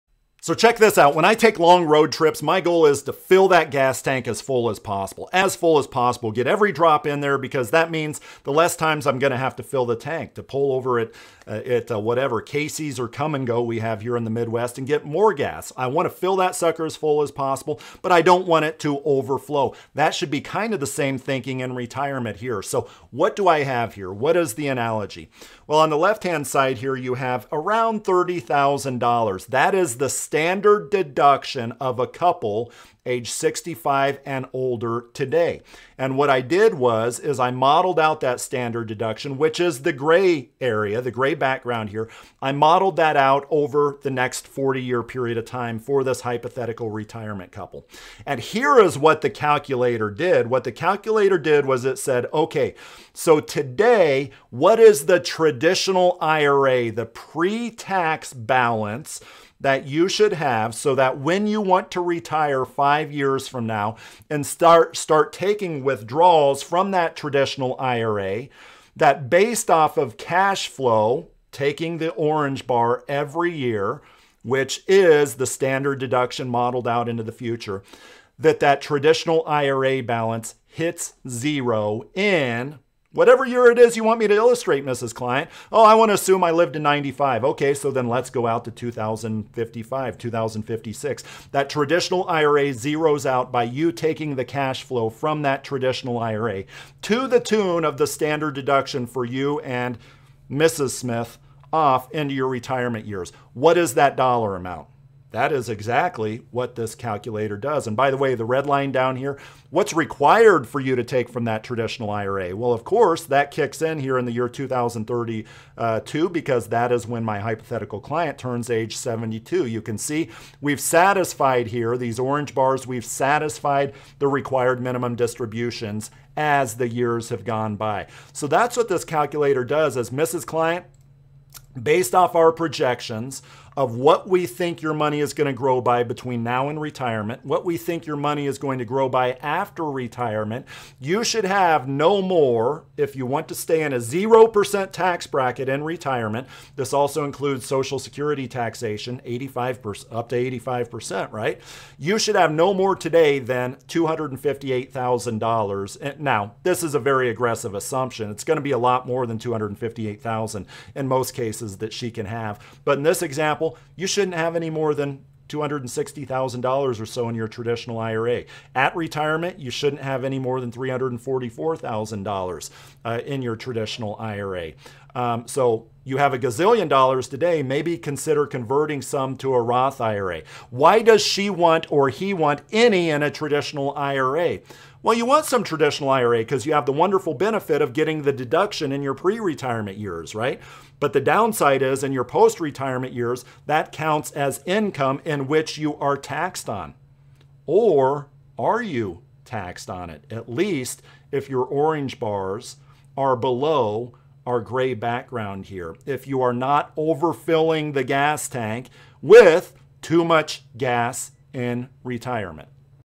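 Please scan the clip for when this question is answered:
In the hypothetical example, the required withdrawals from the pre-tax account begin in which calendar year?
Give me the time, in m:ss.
1:54.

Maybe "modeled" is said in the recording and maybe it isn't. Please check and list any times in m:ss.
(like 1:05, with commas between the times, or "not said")
0:37, 0:42, 1:16.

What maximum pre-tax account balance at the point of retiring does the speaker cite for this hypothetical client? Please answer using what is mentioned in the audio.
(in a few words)
$344,000.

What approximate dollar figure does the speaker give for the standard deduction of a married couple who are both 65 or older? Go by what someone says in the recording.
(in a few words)
$30,000.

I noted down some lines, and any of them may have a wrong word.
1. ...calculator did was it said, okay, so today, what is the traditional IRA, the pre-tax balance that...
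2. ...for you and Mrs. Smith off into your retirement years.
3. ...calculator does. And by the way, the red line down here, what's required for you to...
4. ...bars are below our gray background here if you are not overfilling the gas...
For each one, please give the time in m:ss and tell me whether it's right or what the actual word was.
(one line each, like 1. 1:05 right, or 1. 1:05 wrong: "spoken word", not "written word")
1. 0:50 right
2. 1:39 right
3. 1:46 right
4. 3:22 right.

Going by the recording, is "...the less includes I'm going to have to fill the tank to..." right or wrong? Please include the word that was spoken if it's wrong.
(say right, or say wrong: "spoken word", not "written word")
wrong: "times", not "includes".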